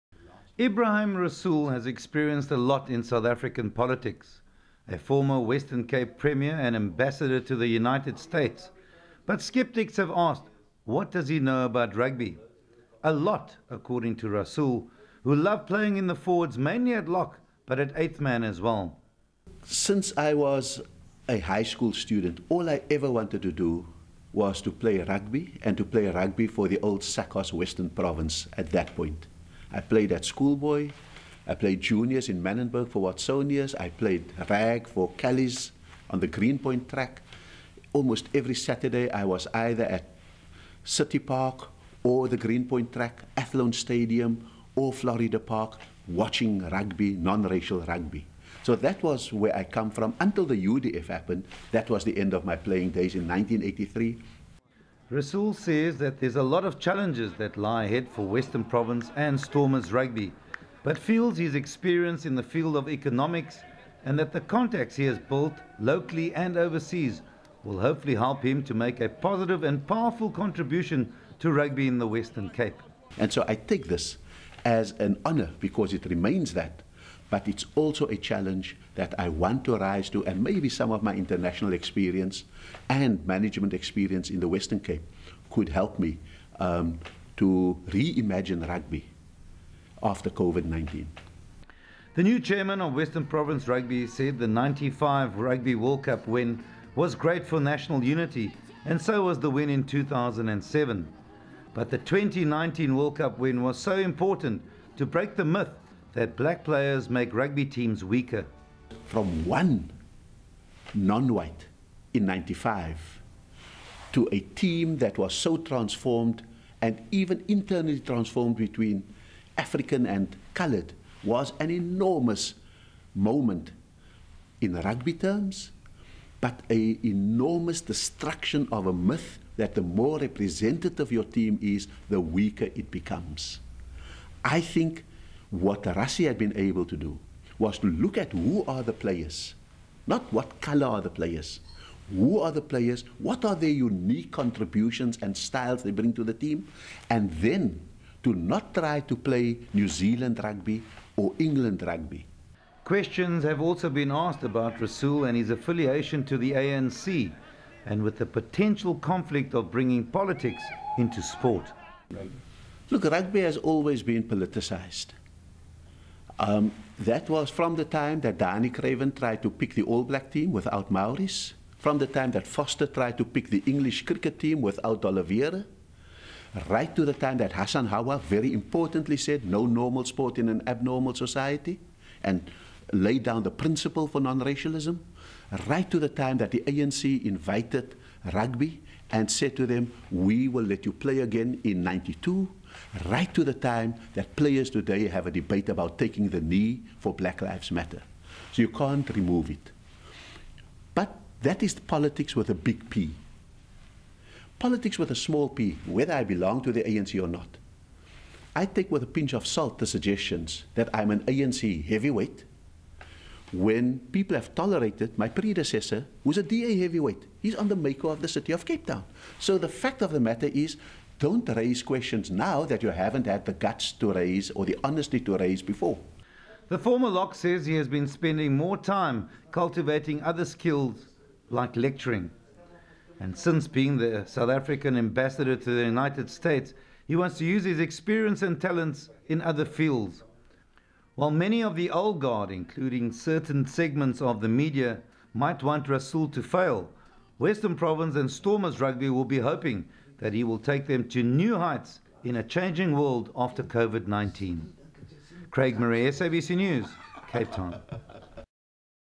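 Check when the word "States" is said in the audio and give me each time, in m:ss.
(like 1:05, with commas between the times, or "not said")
0:08, 3:56.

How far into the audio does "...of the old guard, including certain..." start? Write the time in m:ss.
4:01.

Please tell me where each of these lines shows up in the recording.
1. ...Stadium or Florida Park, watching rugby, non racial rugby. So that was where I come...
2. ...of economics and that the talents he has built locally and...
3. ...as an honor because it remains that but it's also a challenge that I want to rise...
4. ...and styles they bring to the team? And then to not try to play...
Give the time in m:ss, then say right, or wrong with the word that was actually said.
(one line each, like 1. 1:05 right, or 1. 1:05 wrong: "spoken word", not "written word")
1. 0:43 right
2. 1:02 wrong: "contacts", not "talents"
3. 1:14 right
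4. 2:25 right.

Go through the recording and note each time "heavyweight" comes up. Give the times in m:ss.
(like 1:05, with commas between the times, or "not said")
3:31, 3:36.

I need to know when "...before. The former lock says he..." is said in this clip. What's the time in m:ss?
3:45.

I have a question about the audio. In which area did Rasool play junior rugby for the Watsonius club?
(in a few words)
Mannenberg.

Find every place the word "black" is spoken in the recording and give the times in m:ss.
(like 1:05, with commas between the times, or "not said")
1:46, 2:50, 3:17.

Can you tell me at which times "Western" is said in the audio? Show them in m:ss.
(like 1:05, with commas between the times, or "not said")
0:05, 0:27, 0:58, 1:12, 1:24, 1:32, 4:07.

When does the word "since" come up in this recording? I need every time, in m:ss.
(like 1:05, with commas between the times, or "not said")
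0:19, 3:53.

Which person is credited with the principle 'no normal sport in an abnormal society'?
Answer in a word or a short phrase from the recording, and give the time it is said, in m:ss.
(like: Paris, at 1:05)
Hassan Hawa, at 2:57.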